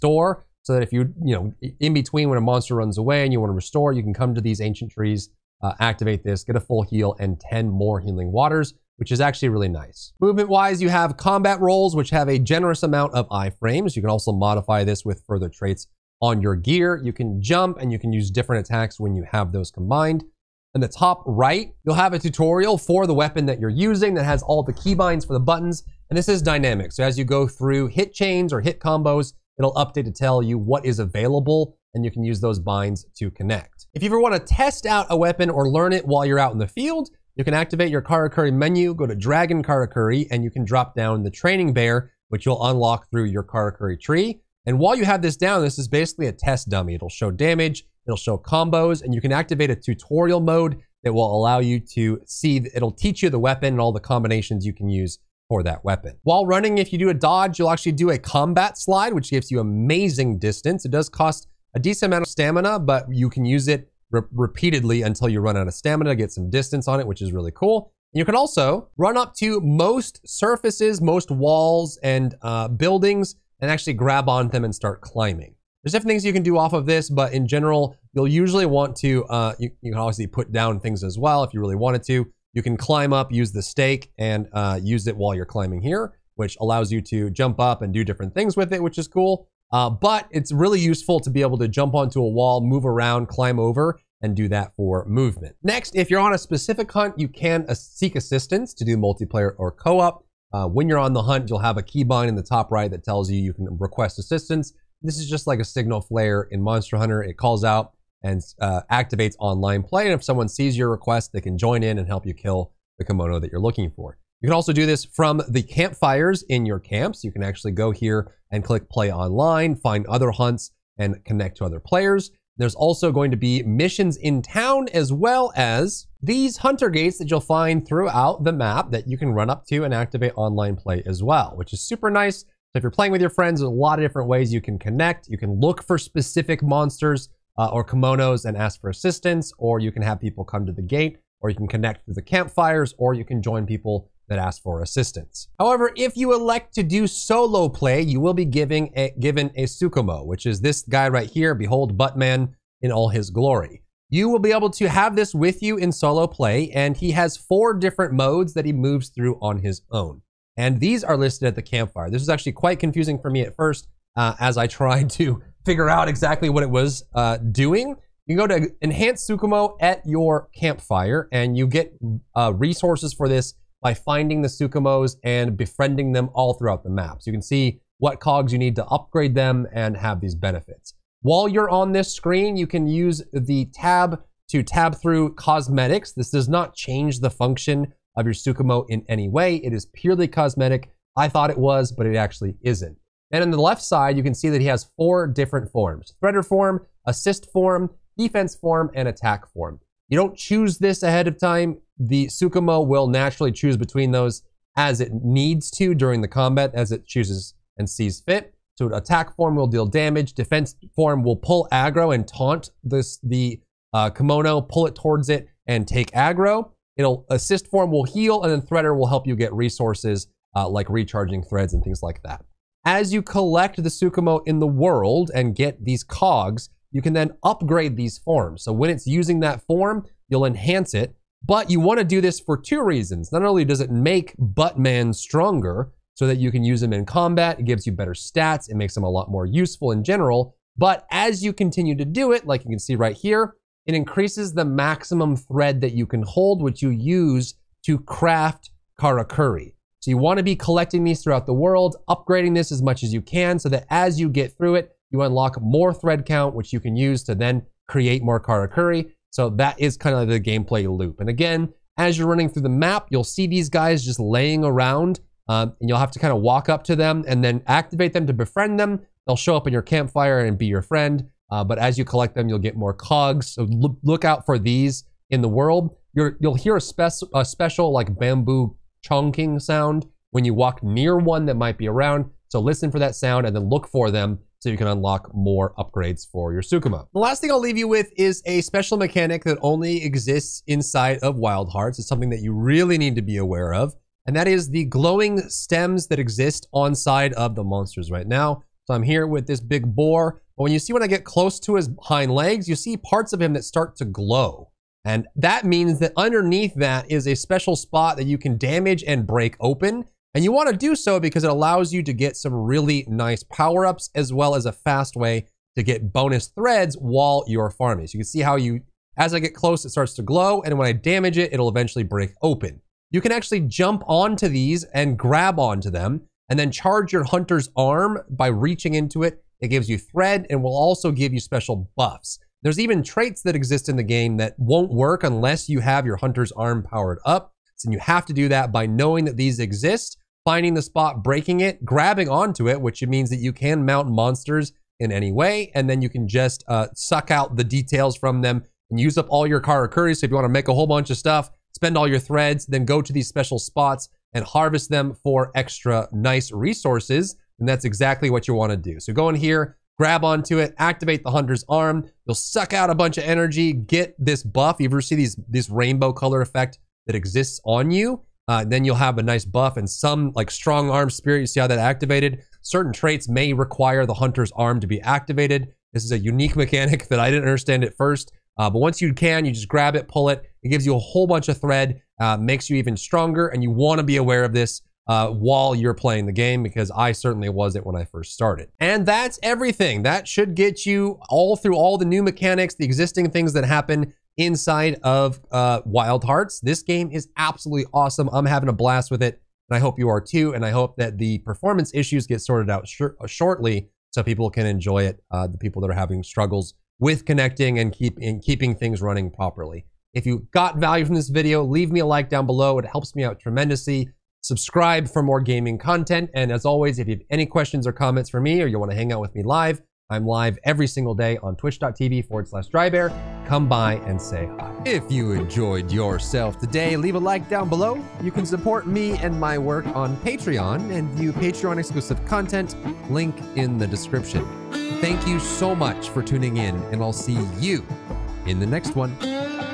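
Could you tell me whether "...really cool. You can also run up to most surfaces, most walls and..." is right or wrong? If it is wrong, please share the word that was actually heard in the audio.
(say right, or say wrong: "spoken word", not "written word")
right.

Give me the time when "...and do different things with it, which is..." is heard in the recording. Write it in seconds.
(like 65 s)
87 s.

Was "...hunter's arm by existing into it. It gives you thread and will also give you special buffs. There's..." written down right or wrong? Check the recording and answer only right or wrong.
wrong.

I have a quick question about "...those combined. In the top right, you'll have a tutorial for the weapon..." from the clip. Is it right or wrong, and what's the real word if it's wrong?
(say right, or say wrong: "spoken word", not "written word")
right.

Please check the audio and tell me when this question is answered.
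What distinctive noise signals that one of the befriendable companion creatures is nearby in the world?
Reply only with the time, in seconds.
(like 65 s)
278 s.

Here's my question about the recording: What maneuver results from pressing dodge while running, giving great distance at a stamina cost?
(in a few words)
combat slide.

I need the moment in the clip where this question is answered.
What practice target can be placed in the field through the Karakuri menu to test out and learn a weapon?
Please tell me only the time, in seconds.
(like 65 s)
41 s.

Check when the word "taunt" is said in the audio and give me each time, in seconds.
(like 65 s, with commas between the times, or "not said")
212 s.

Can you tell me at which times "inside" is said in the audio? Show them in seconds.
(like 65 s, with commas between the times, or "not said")
290 s, 394 s.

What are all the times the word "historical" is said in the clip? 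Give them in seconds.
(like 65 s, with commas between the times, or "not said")
not said.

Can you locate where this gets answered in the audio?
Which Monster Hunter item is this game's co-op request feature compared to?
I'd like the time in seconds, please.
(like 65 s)
105 s.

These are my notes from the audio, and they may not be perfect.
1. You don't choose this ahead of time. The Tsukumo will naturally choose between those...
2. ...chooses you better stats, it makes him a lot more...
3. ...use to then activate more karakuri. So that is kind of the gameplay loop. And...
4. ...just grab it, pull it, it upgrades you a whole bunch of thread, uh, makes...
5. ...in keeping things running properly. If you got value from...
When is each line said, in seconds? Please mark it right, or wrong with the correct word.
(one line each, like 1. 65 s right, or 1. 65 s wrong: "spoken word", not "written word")
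1. 200 s right
2. 237 s wrong: "gives", not "chooses"
3. 256 s wrong: "create", not "activate"
4. 379 s wrong: "gives", not "upgrades"
5. 408 s right.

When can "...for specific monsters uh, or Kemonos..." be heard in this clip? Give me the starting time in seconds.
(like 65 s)
135 s.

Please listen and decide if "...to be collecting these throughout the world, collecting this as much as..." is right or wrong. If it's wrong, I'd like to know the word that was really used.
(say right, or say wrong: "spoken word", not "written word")
wrong: "upgrading", not "collecting".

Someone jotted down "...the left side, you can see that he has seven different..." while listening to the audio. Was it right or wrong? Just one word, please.
wrong.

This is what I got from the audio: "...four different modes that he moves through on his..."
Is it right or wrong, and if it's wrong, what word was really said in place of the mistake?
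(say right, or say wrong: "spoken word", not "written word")
right.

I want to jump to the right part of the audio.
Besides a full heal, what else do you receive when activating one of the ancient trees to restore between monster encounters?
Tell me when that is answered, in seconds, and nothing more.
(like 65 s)
7 s.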